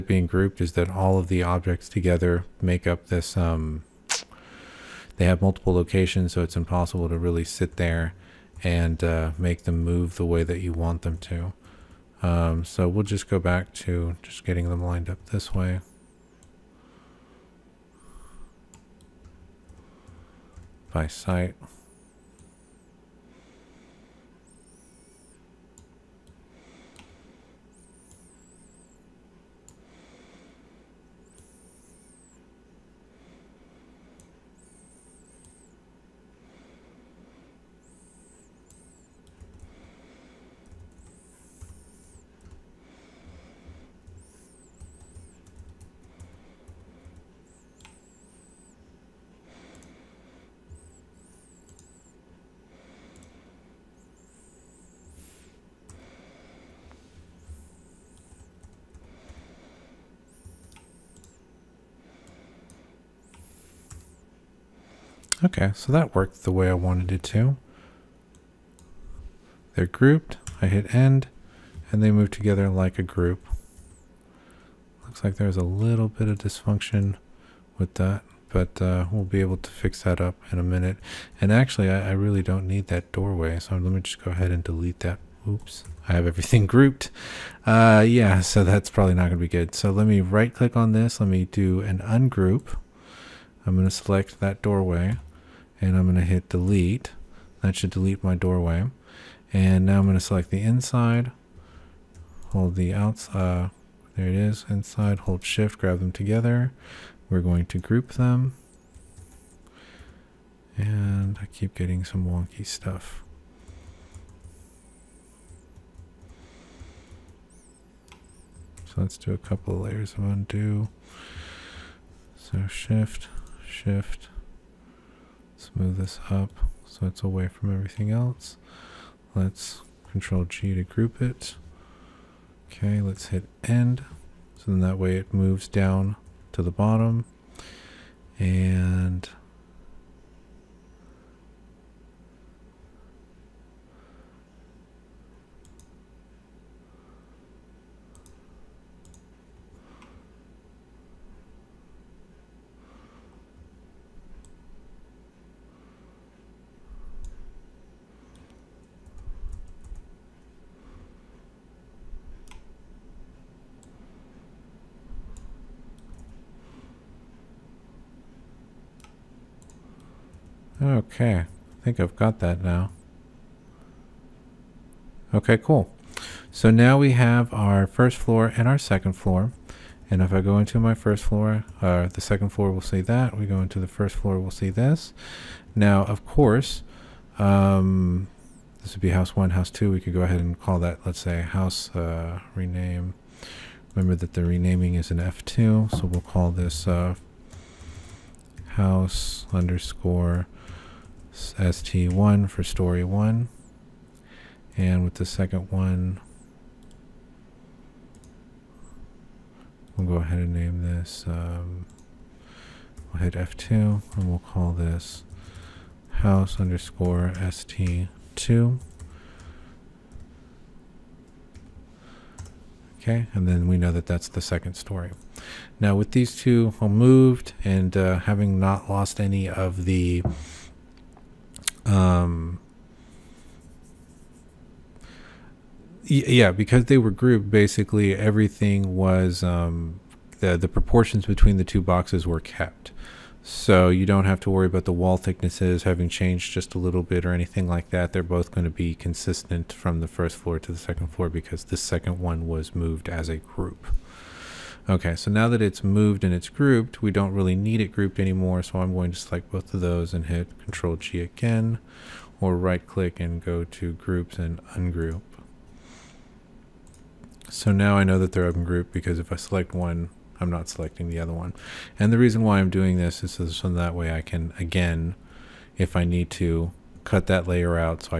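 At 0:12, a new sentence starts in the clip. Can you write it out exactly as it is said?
Um, so we'll just go back to just getting them lined up this way.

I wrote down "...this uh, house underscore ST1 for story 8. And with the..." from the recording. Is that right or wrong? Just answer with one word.
wrong.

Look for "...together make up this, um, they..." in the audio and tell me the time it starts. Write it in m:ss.
0:01.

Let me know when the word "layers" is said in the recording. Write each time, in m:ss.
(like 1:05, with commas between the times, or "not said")
1:59, 4:37.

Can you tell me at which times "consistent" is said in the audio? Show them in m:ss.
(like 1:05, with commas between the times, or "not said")
4:08.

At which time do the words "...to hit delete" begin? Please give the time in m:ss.
1:36.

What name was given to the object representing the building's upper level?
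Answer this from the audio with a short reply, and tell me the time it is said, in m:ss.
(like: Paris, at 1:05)
house_ST2, at 3:36.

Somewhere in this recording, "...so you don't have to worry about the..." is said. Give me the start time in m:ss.
4:03.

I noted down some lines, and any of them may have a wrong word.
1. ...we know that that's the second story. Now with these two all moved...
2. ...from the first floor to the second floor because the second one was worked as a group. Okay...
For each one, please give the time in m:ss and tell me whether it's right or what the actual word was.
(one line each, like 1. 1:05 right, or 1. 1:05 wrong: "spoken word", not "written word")
1. 3:43 right
2. 4:09 wrong: "moved", not "worked".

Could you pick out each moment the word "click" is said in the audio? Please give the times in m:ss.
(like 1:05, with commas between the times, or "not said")
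1:30, 4:22.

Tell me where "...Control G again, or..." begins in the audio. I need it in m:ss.
4:20.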